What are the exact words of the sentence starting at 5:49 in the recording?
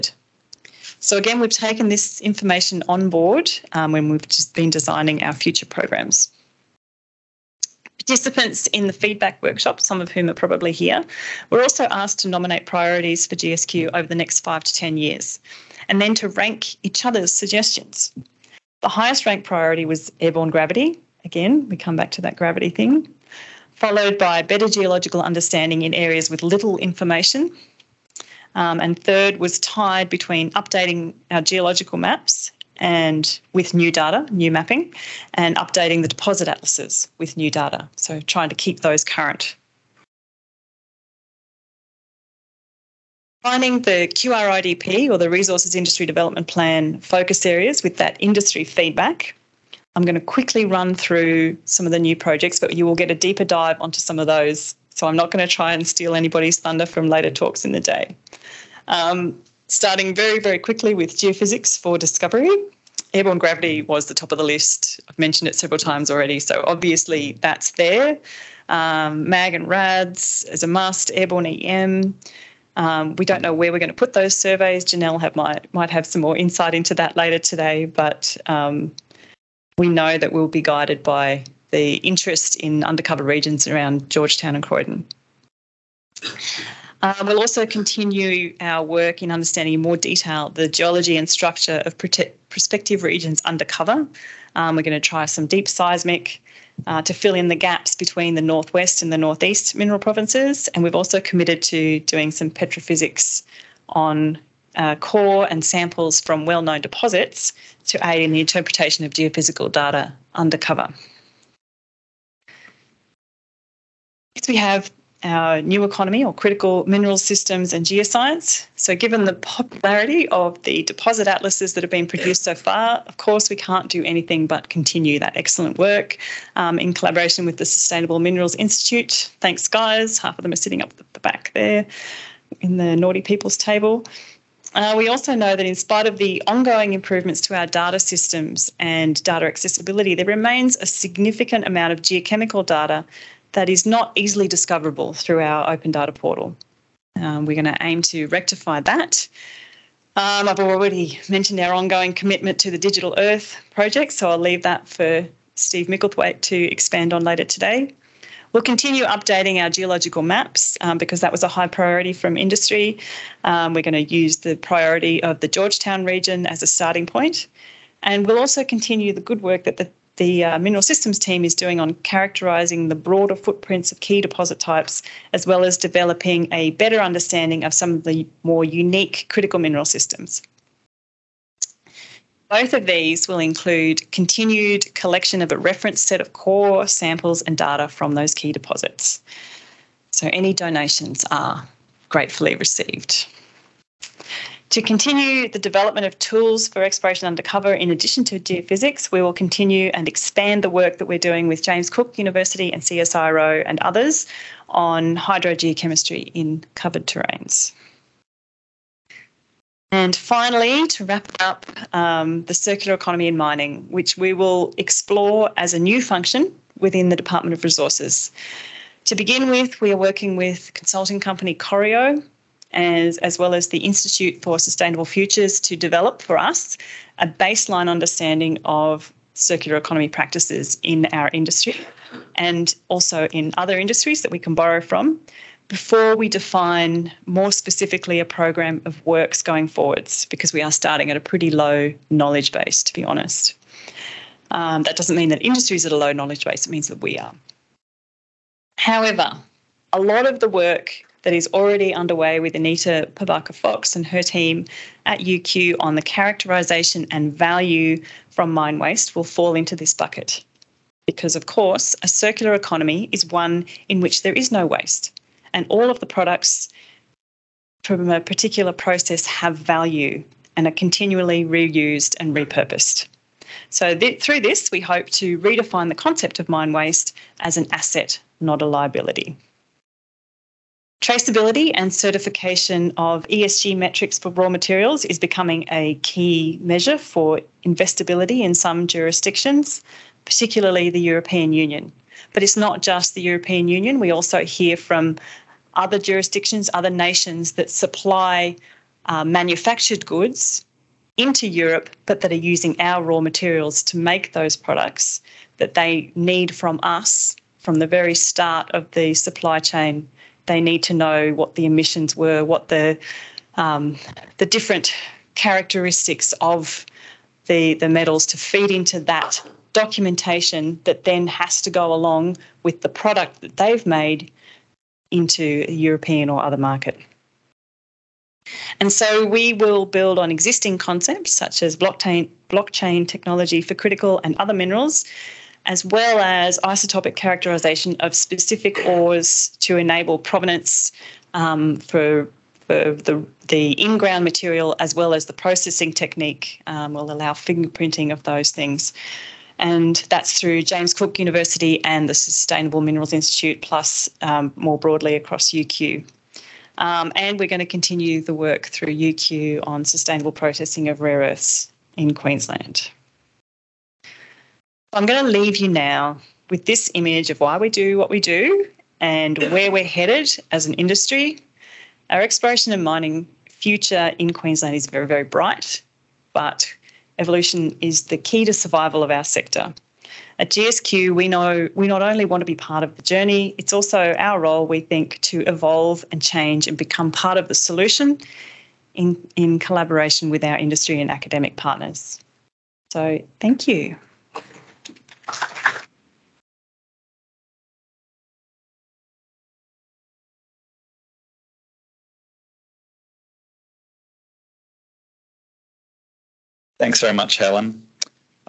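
And that's through James Cook University and the Sustainable Minerals Institute, plus um, more broadly across UQ.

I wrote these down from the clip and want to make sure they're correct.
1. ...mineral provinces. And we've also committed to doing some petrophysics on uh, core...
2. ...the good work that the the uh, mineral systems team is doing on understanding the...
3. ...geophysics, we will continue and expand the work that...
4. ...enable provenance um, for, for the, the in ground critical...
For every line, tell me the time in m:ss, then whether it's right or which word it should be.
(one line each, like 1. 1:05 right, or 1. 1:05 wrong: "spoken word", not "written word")
1. 1:39 right
2. 2:49 wrong: "characterising", not "understanding"
3. 3:18 right
4. 5:39 wrong: "material", not "critical".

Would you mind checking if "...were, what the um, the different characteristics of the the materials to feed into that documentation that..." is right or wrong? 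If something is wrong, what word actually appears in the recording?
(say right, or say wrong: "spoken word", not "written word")
wrong: "metals", not "materials".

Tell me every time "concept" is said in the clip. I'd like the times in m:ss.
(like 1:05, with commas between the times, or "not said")
4:35, 5:30.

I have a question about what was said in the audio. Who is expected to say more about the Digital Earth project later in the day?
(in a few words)
Steve Micklethwaite.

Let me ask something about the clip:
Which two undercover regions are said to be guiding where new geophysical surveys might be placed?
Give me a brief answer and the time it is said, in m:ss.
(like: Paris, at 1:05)
Georgetown and Croydon, at 1:24.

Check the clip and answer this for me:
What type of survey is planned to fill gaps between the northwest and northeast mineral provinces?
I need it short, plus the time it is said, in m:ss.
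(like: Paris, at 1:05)
Deep seismic, at 1:35.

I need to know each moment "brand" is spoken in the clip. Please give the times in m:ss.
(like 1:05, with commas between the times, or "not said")
not said.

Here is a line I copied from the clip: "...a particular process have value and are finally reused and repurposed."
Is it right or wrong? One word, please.
wrong.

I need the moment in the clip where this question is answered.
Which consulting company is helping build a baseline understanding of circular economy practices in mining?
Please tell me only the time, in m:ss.
3:41.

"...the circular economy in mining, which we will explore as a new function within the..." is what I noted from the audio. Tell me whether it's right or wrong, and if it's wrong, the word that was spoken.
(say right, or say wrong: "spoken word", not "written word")
right.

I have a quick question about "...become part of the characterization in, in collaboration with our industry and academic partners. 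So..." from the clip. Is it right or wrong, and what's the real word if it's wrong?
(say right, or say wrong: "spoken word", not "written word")
wrong: "solution", not "characterization".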